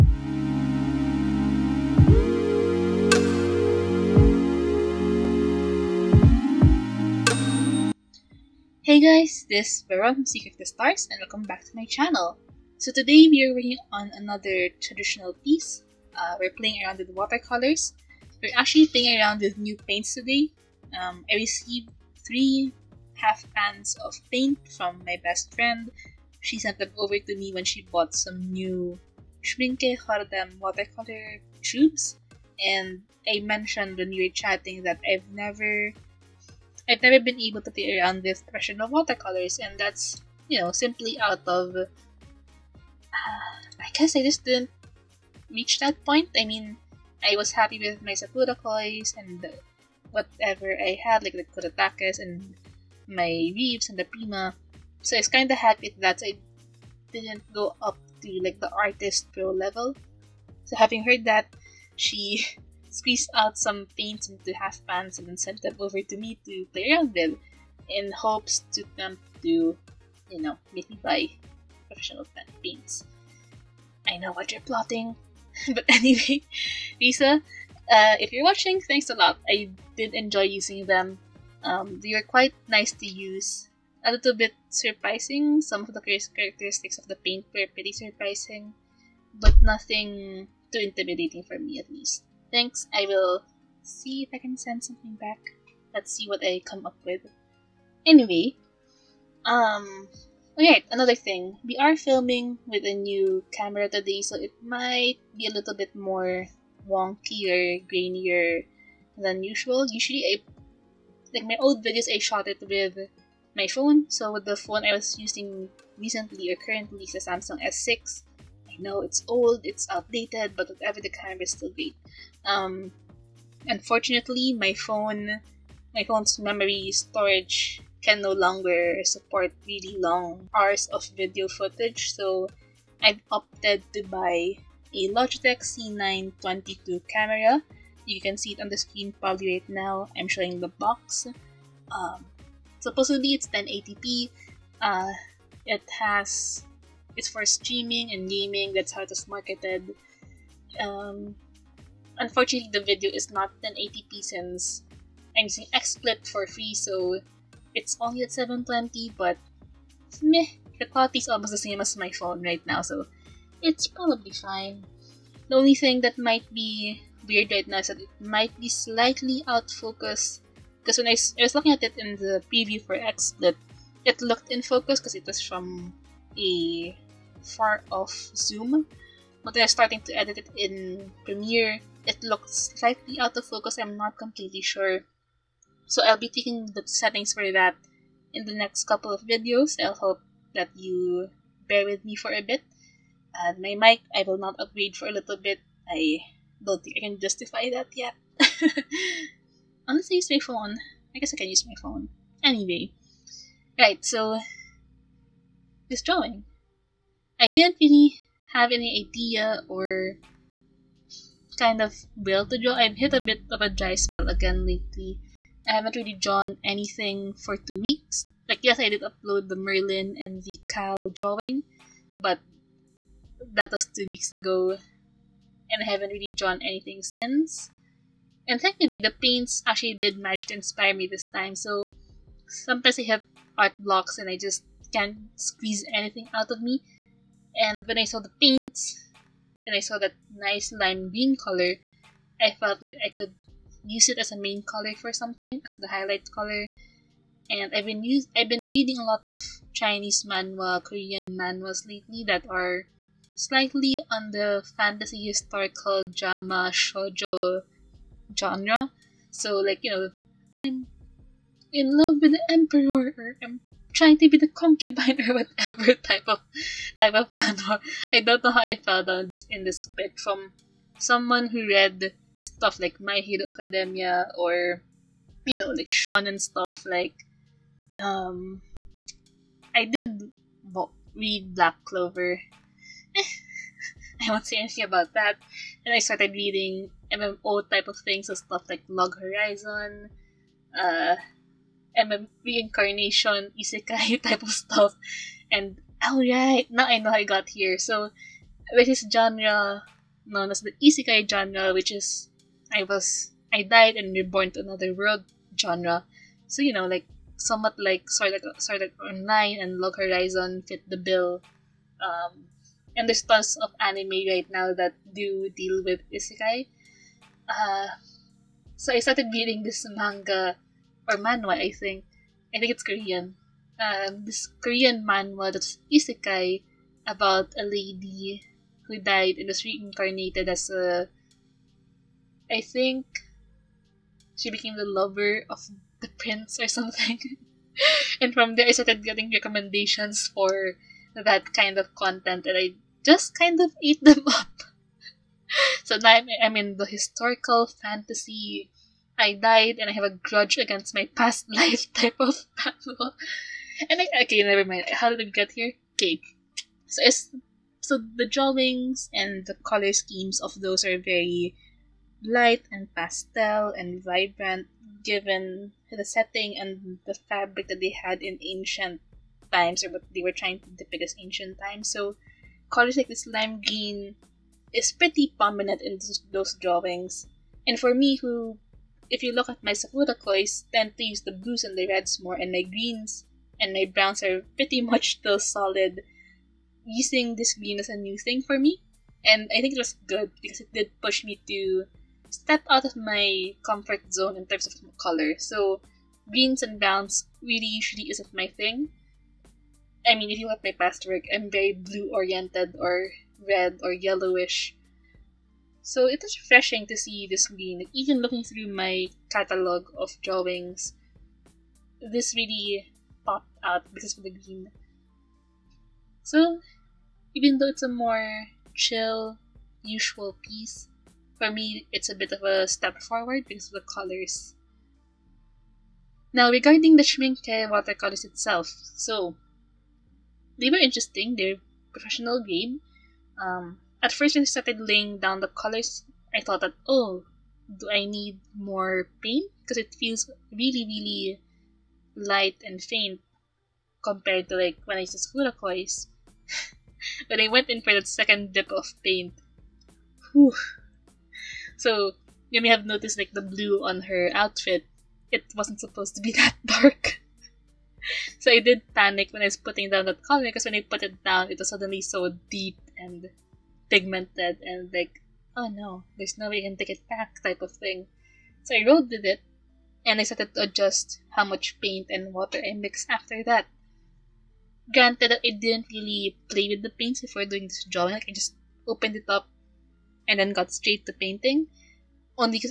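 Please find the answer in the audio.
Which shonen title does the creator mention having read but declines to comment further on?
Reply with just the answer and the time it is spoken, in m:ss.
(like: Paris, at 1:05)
Black Clover, at 4:41.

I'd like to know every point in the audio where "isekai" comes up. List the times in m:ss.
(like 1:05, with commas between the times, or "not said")
4:53, 5:00, 5:16, 5:25.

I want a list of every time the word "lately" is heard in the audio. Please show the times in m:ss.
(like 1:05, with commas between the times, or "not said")
3:34, 4:11.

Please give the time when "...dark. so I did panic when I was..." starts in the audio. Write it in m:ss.
7:36.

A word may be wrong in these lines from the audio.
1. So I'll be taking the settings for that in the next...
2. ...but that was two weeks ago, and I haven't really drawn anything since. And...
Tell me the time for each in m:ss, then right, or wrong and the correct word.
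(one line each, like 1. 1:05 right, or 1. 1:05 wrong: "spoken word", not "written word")
1. 3:05 right
2. 3:42 right.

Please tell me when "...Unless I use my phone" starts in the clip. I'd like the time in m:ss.
3:19.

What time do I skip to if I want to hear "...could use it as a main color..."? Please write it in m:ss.
4:03.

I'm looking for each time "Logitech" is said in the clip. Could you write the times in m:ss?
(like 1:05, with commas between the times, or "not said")
2:15.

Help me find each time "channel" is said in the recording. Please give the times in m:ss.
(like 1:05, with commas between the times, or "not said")
0:11.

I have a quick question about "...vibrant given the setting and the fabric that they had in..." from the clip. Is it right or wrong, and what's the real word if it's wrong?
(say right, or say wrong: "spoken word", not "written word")
right.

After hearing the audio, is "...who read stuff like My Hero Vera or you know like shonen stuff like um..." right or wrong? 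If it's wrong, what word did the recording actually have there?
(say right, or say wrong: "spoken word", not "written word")
wrong: "Academia", not "Vera".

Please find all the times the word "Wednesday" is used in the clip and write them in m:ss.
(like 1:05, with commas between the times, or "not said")
not said.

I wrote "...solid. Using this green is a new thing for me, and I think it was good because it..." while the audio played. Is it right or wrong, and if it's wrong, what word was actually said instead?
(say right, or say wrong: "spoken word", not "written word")
right.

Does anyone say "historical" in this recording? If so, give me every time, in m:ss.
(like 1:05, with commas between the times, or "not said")
4:15, 5:46.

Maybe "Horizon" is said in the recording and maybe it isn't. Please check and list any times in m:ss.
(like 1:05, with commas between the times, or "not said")
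4:49, 5:09.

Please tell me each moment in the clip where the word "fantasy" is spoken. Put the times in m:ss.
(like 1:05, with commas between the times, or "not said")
4:14, 5:47.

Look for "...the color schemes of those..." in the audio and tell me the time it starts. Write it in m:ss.
5:59.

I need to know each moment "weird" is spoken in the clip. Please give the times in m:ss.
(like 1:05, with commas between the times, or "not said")
2:47.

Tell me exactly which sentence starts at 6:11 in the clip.
So colors like this lime green is pretty prominent in those, those drawings.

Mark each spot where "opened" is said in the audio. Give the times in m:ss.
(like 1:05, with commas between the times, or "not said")
7:58.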